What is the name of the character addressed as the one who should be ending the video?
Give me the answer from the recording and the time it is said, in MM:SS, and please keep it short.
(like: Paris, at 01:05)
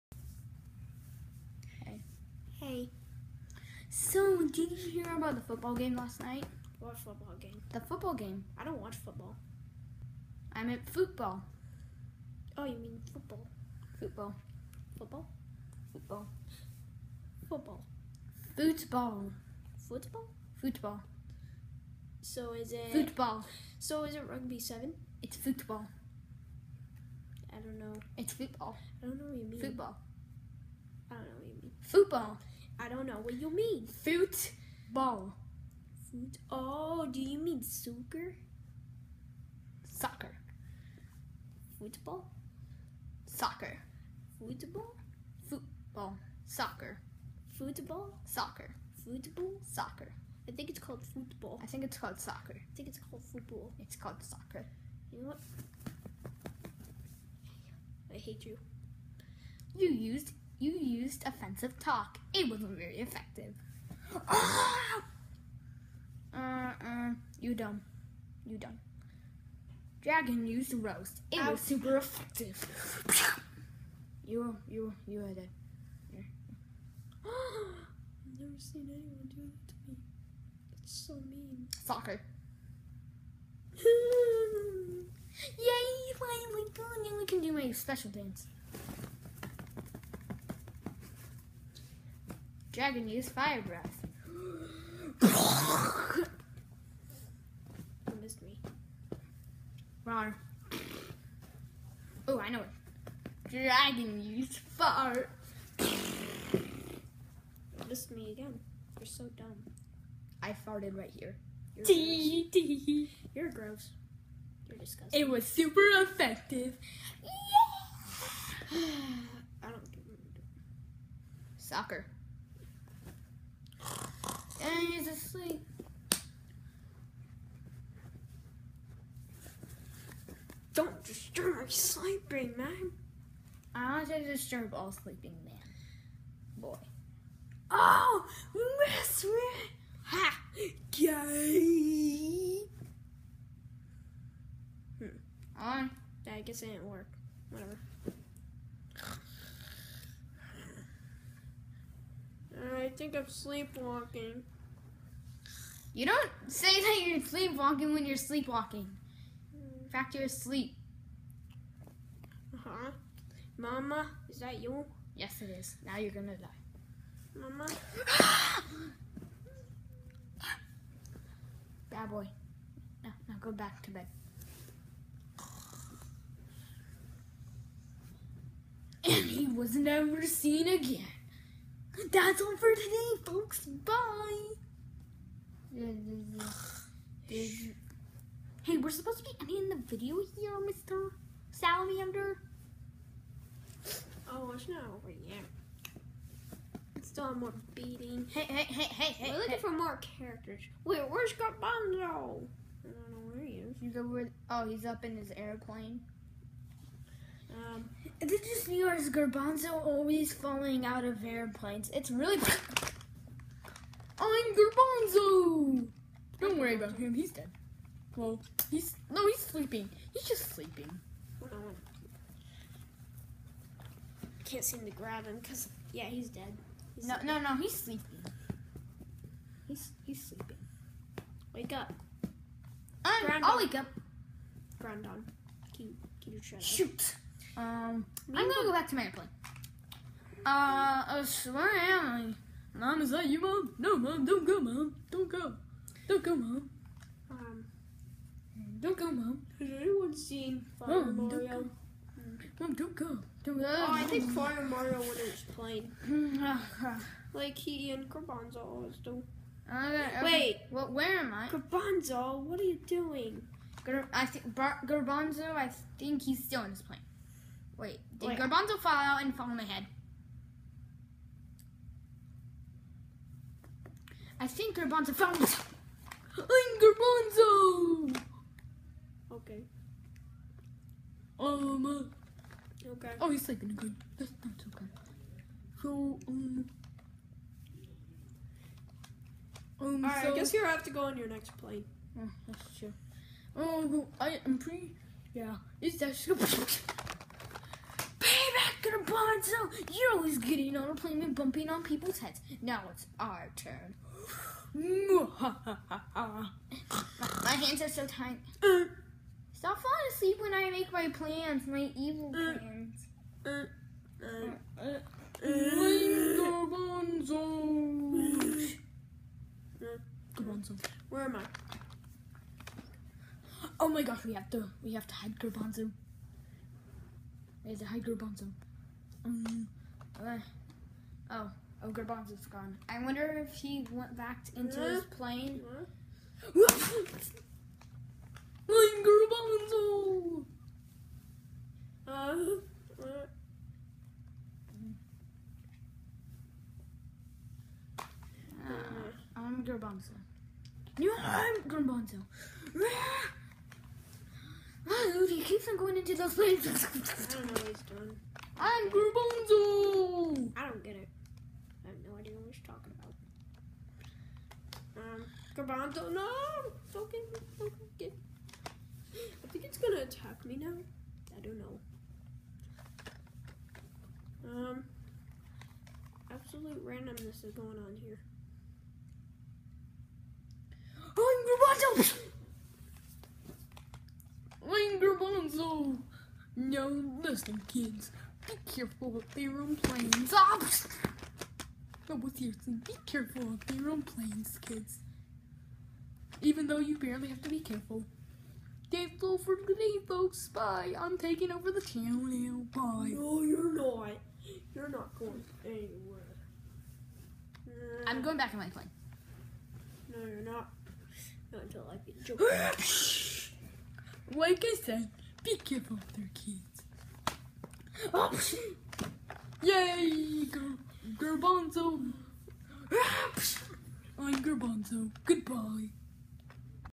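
Mr. Salamander, at 03:10.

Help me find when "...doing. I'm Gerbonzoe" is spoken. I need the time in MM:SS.
05:57.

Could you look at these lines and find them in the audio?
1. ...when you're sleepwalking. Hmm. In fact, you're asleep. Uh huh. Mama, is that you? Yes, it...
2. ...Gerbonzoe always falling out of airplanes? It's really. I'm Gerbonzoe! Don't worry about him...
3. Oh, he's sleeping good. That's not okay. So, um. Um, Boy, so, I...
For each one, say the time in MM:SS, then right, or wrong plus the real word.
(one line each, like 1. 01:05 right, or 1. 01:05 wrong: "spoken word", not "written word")
1. 02:37 right
2. 03:29 right
3. 04:43 wrong: "Alright", not "Boy".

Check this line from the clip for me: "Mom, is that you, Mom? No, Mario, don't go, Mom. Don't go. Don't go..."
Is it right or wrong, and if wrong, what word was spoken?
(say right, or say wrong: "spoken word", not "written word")
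wrong: "Mom", not "Mario".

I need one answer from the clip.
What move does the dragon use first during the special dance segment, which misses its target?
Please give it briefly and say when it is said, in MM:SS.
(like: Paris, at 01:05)
Fire breath, at 01:32.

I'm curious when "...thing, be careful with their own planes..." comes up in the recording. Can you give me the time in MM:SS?
06:32.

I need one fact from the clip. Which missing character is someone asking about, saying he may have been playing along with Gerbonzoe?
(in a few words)
Fire Mario.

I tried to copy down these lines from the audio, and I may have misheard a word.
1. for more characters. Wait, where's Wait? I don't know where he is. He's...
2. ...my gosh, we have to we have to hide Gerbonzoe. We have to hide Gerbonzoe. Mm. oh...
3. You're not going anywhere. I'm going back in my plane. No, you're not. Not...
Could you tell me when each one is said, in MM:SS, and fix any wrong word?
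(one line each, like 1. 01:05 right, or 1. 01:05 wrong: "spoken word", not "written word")
1. 03:19 wrong: "Gerbonzoe", not "Wait"
2. 05:23 right
3. 06:44 right.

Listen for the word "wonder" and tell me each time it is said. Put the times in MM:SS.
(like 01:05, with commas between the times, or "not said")
05:33.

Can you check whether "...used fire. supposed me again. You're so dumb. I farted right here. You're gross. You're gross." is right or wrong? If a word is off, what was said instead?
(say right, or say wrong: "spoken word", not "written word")
wrong: "missed", not "supposed".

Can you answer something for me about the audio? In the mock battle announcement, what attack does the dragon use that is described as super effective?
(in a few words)
Roast.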